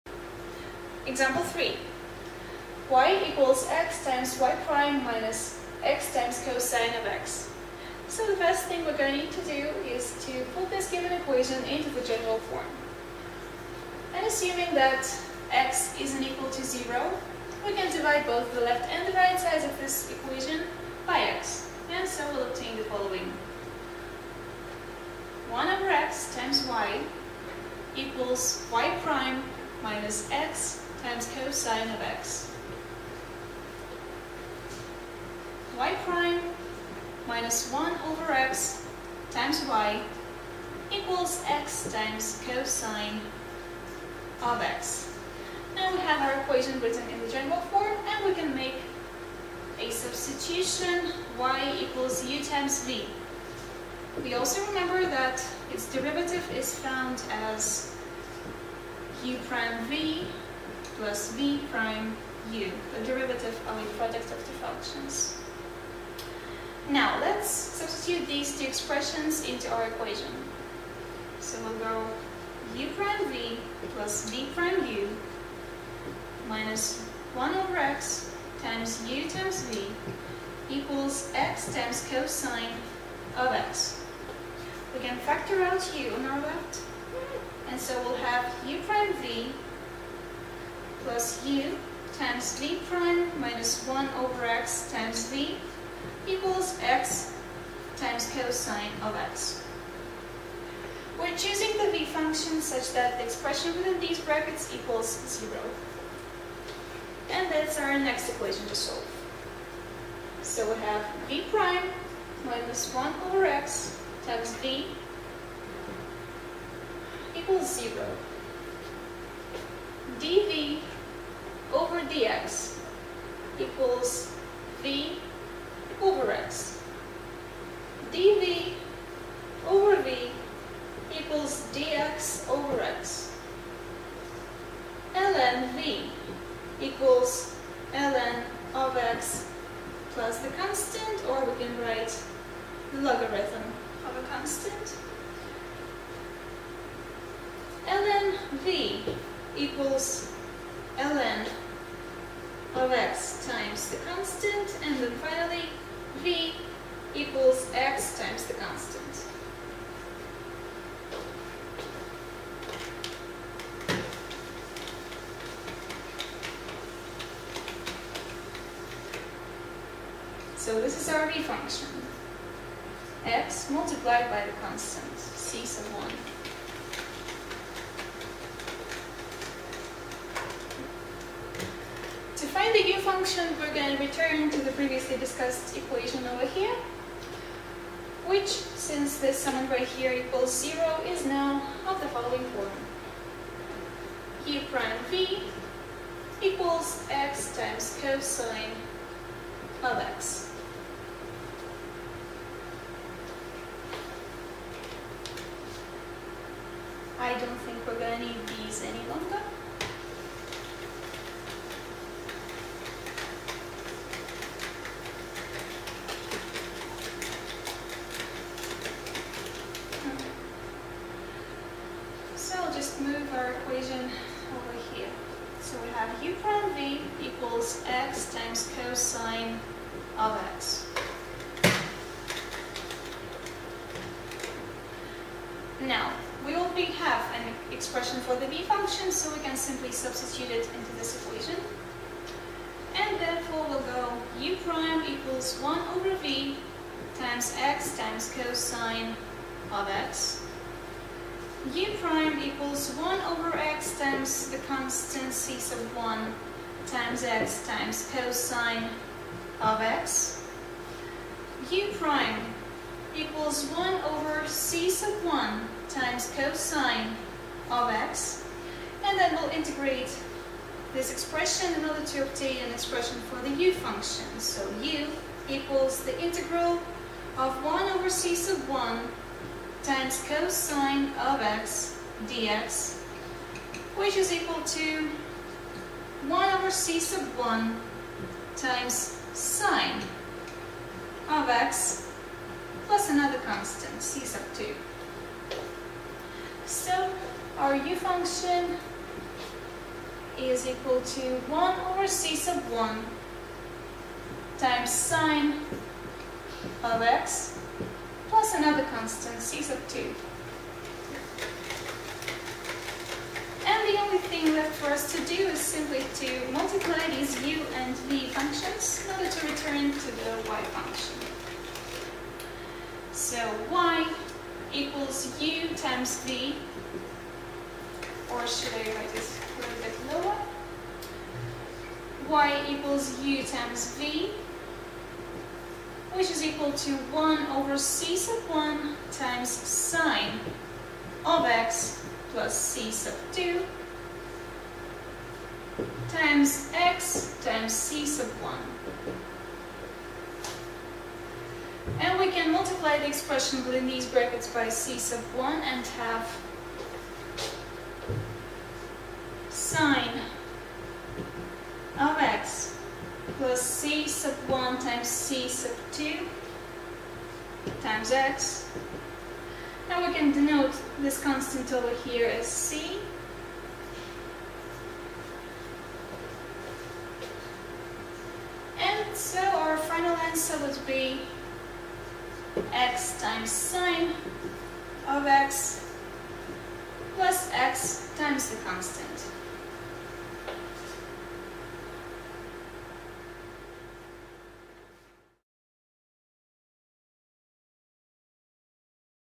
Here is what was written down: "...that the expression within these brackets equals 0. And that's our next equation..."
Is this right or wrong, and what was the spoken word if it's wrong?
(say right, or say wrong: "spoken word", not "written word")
right.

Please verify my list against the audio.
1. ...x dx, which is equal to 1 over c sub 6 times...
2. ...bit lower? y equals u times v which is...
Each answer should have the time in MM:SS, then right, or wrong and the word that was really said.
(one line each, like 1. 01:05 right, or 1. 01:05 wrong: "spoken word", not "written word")
1. 04:41 wrong: "1", not "6"
2. 05:29 right.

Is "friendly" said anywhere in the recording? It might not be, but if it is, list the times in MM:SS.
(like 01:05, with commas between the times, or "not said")
not said.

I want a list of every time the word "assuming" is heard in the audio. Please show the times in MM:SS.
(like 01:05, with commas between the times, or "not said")
00:14.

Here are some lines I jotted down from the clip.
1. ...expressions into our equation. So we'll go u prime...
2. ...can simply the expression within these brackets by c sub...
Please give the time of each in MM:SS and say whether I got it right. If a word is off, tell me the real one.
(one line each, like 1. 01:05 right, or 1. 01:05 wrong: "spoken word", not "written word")
1. 01:08 right
2. 05:52 wrong: "multiply", not "simply".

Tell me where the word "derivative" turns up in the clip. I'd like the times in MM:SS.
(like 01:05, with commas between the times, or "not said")
00:55, 01:03.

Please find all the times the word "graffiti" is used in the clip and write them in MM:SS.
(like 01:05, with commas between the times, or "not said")
not said.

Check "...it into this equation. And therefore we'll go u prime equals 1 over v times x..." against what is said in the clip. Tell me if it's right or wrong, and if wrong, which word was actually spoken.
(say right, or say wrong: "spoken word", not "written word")
right.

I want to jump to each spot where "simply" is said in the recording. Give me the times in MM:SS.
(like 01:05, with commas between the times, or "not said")
03:59, 05:15.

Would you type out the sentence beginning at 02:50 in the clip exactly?
So this is our v function, x multiplied by the constant, c sub 1.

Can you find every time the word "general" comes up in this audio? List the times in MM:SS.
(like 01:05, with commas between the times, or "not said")
00:12, 00:47.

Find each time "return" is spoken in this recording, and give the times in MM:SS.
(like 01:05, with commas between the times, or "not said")
03:04, 05:19.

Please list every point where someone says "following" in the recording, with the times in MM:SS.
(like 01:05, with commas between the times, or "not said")
00:22, 03:12.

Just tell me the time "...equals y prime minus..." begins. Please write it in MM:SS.
00:27.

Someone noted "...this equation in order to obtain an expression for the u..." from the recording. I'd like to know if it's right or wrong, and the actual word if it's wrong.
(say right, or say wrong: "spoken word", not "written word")
wrong: "expression", not "equation".